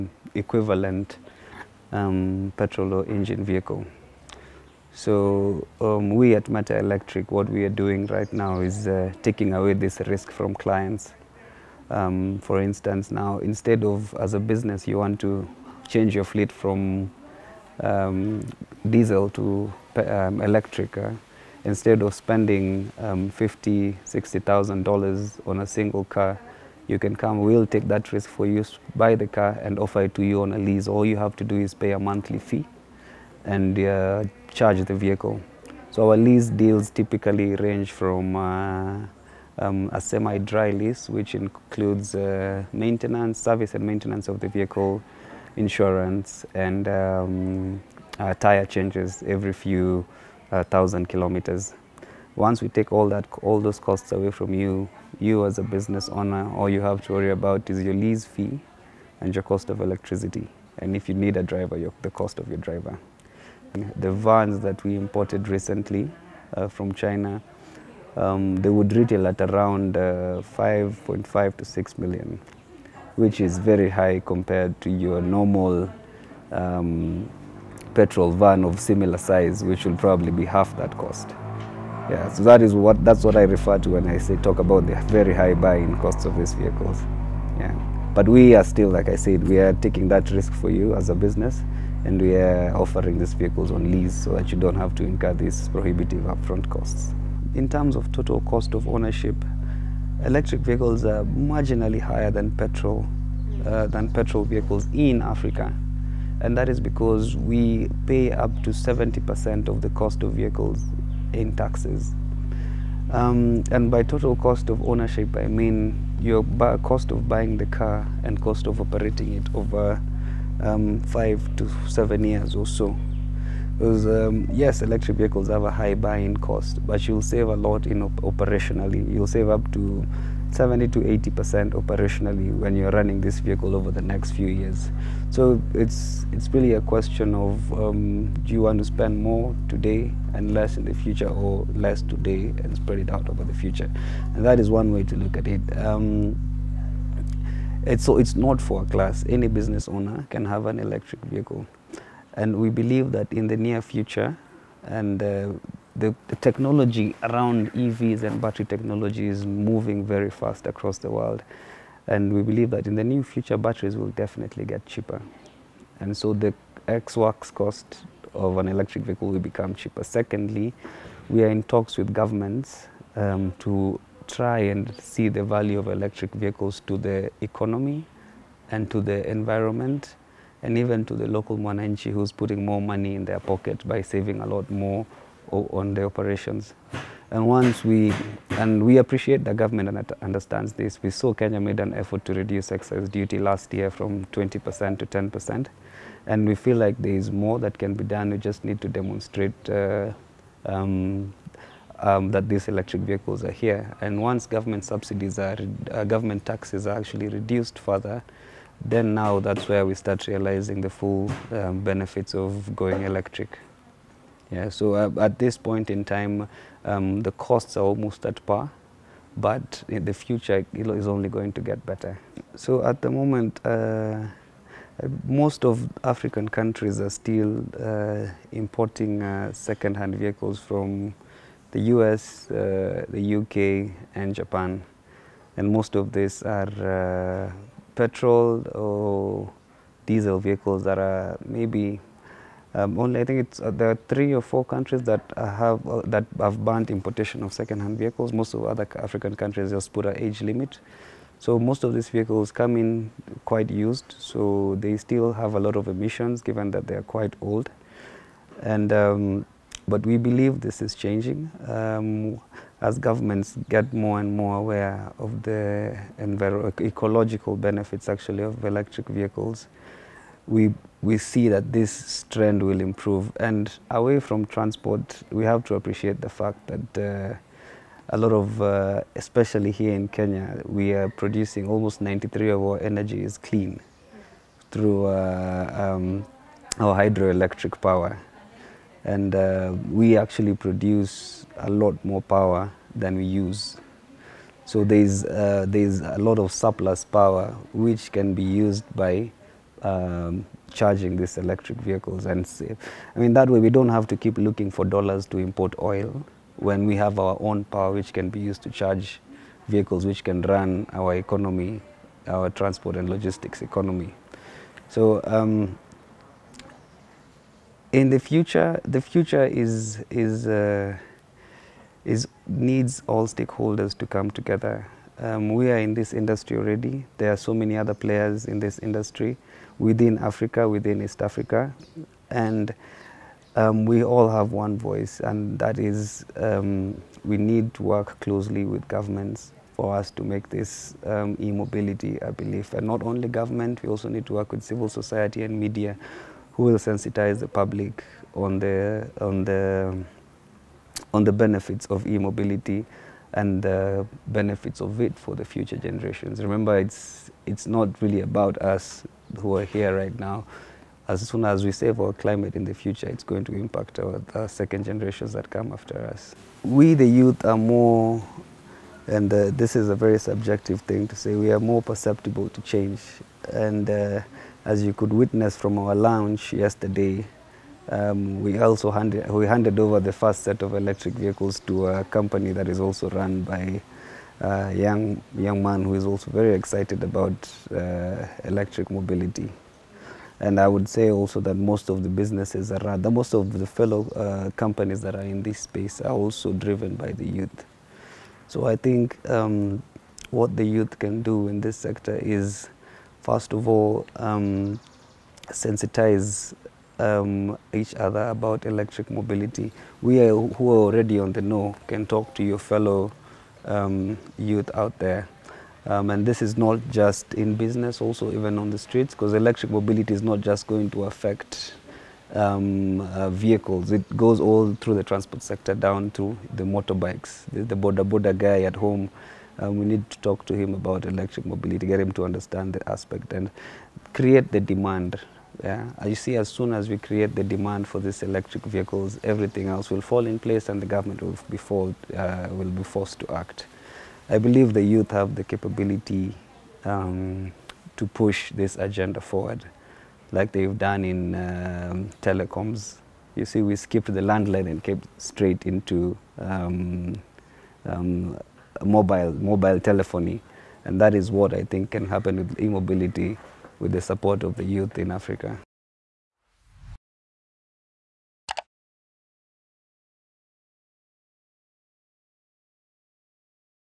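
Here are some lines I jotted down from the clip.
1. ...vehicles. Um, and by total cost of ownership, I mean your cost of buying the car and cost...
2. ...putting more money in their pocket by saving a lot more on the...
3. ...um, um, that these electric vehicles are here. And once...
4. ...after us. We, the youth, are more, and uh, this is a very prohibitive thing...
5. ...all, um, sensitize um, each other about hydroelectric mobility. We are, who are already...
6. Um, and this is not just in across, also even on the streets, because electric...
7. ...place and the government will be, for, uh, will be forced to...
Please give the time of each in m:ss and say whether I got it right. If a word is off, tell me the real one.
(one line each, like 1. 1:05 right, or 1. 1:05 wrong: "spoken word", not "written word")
1. 1:51 wrong: "taxes", not "vehicles"
2. 3:02 right
3. 3:20 right
4. 6:05 wrong: "subjective", not "prohibitive"
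5. 6:43 wrong: "electric", not "hydroelectric"
6. 6:55 wrong: "business", not "across"
7. 7:20 right.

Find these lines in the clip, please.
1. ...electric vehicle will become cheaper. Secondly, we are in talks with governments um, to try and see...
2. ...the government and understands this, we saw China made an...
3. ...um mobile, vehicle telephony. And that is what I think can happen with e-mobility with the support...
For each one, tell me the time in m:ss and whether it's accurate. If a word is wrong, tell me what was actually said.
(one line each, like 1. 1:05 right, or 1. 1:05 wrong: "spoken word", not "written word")
1. 2:48 right
2. 3:09 wrong: "Kenya", not "China"
3. 7:37 wrong: "mobile", not "vehicle".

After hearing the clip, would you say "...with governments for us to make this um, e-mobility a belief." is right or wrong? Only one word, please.
right.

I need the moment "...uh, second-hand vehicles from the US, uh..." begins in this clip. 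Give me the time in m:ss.
3:49.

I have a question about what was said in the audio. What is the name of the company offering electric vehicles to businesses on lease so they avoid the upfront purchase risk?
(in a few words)
Meta Electric.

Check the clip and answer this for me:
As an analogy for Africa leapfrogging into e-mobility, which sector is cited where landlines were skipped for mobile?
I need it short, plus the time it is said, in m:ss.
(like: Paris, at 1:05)
Telecoms, at 7:32.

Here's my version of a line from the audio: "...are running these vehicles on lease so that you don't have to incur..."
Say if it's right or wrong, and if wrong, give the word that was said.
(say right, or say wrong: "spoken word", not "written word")
wrong: "offering", not "running".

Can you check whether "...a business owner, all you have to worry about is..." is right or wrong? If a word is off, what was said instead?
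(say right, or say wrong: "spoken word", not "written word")
right.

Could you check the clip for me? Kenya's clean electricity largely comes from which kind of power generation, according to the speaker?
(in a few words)
Hydroelectric.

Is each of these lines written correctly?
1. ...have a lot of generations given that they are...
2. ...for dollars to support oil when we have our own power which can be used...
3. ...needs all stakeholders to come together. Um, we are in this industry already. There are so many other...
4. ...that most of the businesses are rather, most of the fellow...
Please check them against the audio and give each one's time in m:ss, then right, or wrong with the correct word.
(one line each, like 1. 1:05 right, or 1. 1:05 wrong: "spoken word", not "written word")
1. 4:15 wrong: "emissions", not "generations"
2. 5:04 wrong: "import", not "support"
3. 5:22 right
4. 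6:31 right.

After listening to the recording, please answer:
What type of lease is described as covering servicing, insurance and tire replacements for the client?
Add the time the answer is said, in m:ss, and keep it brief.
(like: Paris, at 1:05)
Semi-dry lease, at 0:40.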